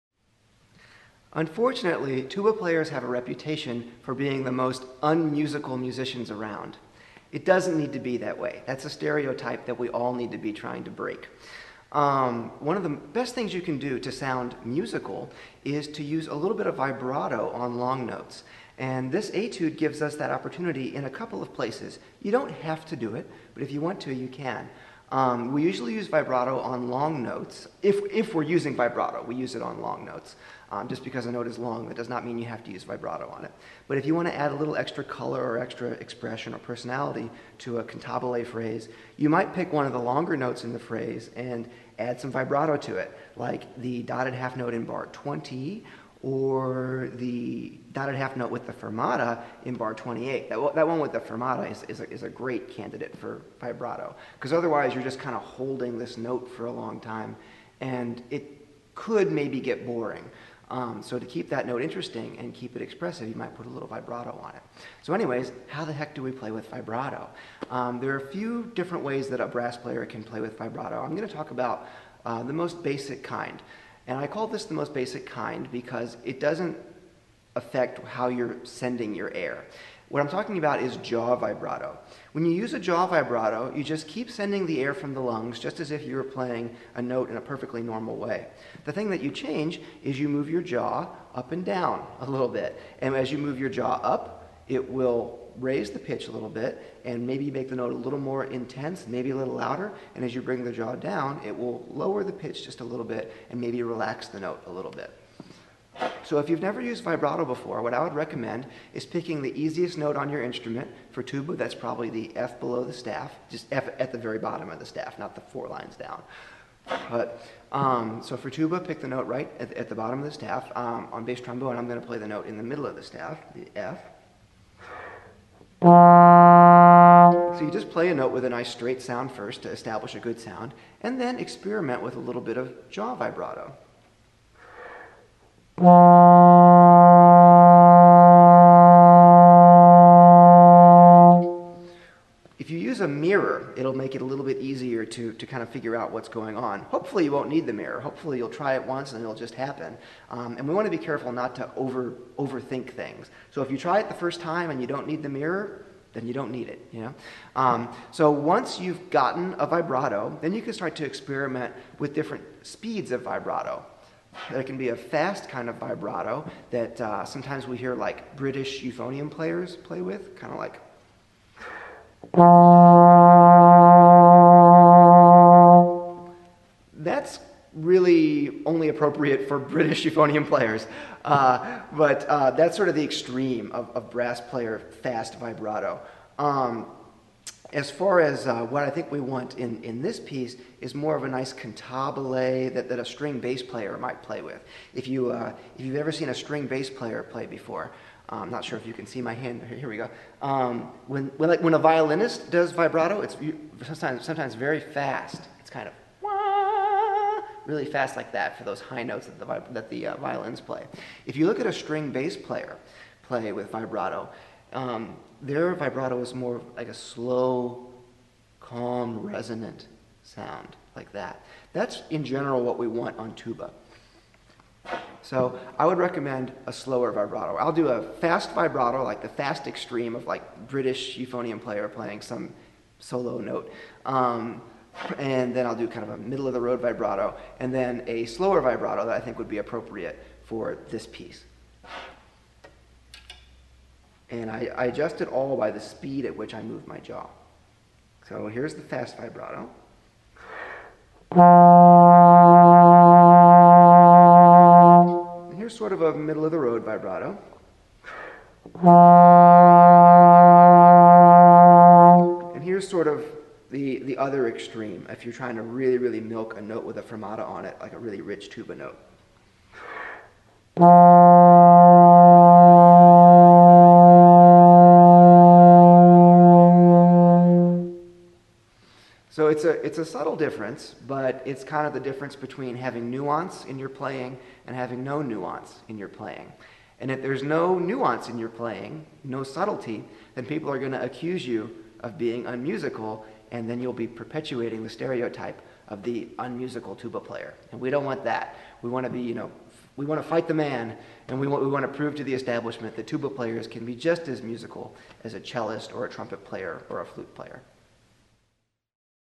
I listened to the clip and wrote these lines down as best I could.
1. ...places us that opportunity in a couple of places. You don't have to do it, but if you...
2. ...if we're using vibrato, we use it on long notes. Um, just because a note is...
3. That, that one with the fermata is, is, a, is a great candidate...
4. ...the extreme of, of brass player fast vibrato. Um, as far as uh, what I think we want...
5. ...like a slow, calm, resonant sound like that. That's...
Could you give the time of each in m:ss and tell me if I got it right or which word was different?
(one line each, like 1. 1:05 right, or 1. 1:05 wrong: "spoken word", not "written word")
1. 0:19 wrong: "gives", not "places"
2. 0:28 right
3. 0:50 right
4. 3:02 right
5. 3:36 right.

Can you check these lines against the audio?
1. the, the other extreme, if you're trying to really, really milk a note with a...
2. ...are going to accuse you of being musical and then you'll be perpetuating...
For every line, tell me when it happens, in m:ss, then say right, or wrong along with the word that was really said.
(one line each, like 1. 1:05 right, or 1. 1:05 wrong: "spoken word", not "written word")
1. 4:23 right
2. 4:50 wrong: "unmusical", not "musical".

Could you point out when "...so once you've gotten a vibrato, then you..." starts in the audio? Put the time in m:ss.
2:38.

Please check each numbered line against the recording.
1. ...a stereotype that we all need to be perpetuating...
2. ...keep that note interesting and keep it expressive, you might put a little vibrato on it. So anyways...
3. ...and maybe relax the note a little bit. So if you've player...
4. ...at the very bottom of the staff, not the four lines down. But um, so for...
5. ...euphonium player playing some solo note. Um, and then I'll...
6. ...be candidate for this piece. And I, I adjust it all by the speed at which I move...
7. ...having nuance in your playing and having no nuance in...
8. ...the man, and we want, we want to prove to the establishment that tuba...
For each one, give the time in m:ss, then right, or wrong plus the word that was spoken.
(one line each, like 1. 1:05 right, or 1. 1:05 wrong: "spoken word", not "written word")
1. 0:08 wrong: "trying", not "perpetuating"
2. 1:01 right
3. 1:43 wrong: "never", not "player"
4. 1:53 right
5. 3:51 right
6. 3:59 wrong: "appropriate", not "candidate"
7. 4:42 right
8. 5:00 right.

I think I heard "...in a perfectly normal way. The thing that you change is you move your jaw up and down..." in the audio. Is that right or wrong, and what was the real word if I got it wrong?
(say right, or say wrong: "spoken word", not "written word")
right.